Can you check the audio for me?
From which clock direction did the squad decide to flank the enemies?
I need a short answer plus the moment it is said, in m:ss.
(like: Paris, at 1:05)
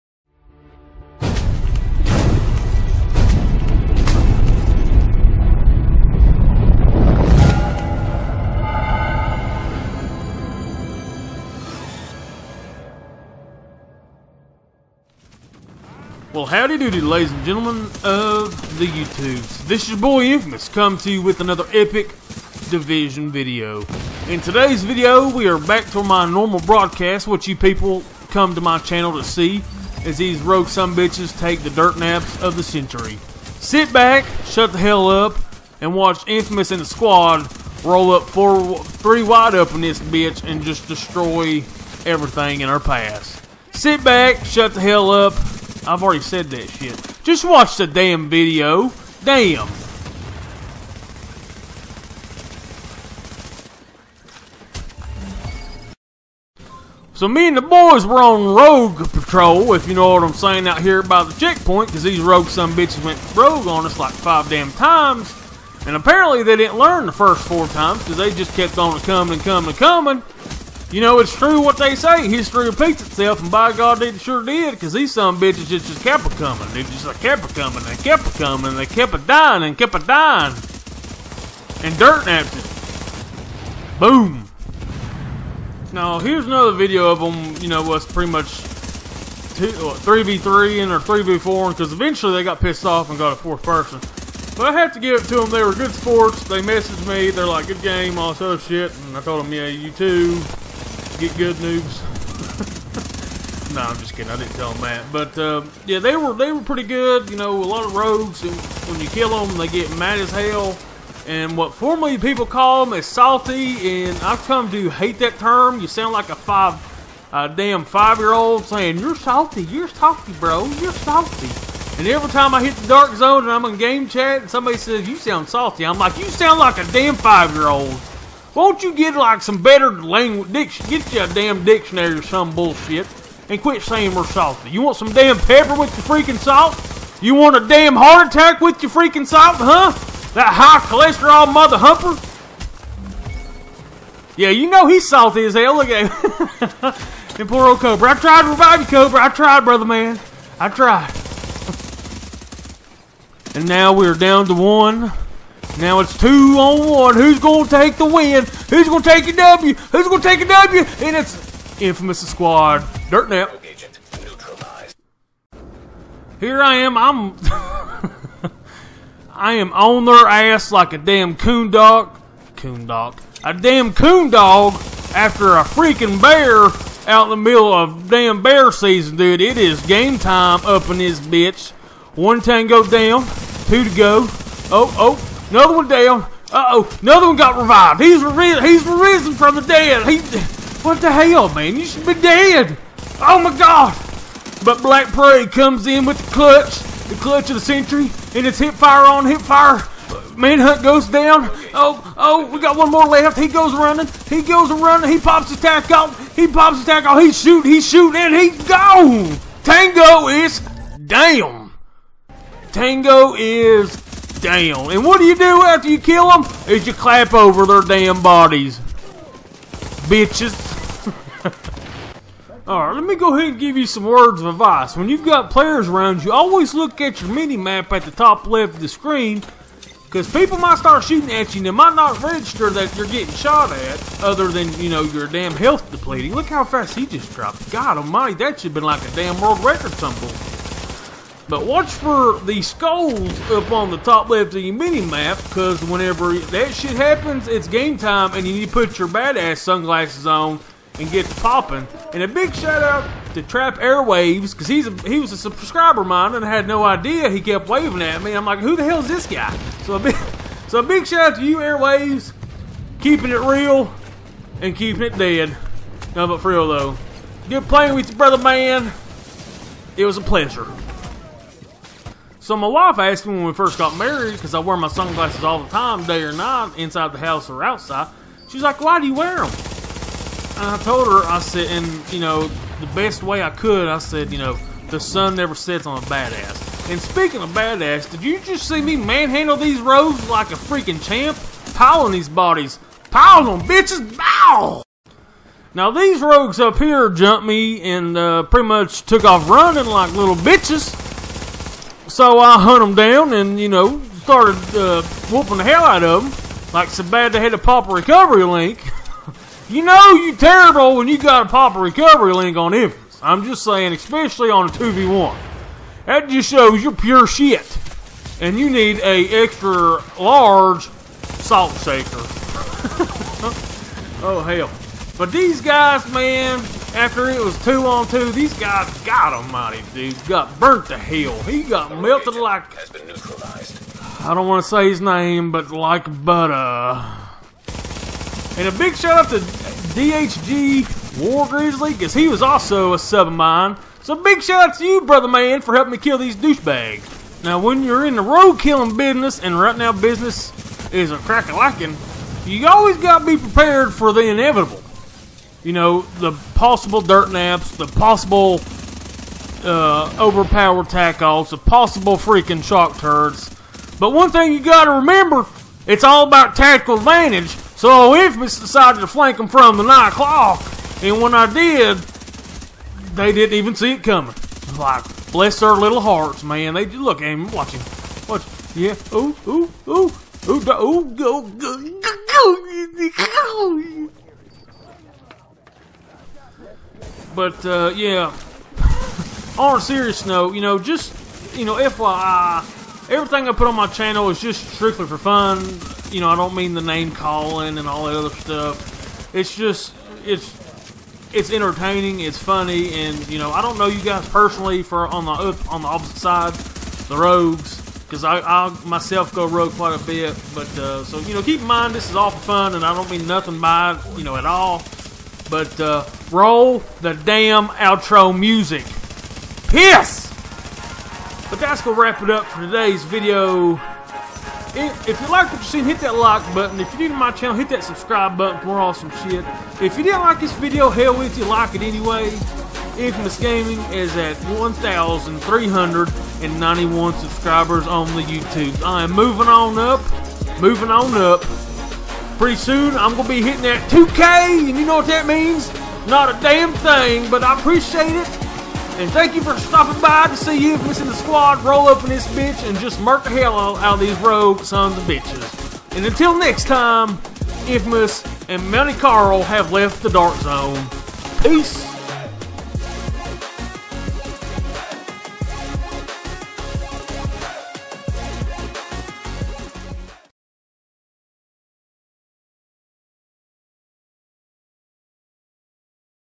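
9 o'clock, at 6:09.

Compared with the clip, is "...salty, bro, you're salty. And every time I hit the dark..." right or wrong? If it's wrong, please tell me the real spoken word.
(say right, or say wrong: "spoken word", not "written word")
right.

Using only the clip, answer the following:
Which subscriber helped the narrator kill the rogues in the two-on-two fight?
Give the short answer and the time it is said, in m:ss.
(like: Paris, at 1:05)
DHG War Grizzly, at 5:39.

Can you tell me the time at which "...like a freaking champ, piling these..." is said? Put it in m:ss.
4:50.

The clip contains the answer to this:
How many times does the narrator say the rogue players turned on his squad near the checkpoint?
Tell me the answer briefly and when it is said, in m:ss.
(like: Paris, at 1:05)
5, at 1:04.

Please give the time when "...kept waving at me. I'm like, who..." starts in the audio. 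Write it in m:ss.
4:17.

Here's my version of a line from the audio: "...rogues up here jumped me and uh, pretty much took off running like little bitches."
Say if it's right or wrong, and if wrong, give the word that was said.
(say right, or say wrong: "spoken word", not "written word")
right.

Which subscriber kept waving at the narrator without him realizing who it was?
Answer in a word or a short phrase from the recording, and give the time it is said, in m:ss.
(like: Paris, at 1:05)
Trap Airwaves, at 4:13.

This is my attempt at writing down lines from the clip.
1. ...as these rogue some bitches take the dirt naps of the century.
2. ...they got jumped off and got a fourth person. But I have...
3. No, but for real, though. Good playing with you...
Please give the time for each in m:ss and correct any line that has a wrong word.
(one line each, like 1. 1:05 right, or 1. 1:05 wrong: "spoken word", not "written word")
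1. 0:30 right
2. 1:32 wrong: "pissed", not "jumped"
3. 4:26 right.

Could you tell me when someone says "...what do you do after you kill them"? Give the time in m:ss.
3:35.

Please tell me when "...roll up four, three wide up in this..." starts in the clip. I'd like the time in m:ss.
0:37.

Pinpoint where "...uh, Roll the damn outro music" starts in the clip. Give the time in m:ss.
6:55.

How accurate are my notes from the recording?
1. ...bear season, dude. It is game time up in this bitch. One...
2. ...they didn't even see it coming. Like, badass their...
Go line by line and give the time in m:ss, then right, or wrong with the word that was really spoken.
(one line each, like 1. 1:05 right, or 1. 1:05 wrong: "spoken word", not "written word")
1. 2:58 right
2. 6:13 wrong: "bless", not "badass".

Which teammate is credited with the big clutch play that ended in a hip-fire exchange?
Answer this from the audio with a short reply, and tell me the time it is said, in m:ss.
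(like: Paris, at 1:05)
Black Prey, at 3:14.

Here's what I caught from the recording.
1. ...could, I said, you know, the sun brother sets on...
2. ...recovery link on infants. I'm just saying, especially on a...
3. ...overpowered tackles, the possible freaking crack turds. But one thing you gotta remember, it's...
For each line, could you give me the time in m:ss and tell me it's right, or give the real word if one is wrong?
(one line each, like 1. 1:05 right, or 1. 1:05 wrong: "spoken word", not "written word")
1. 4:43 wrong: "never", not "brother"
2. 5:11 right
3. 6:00 wrong: "shock", not "crack".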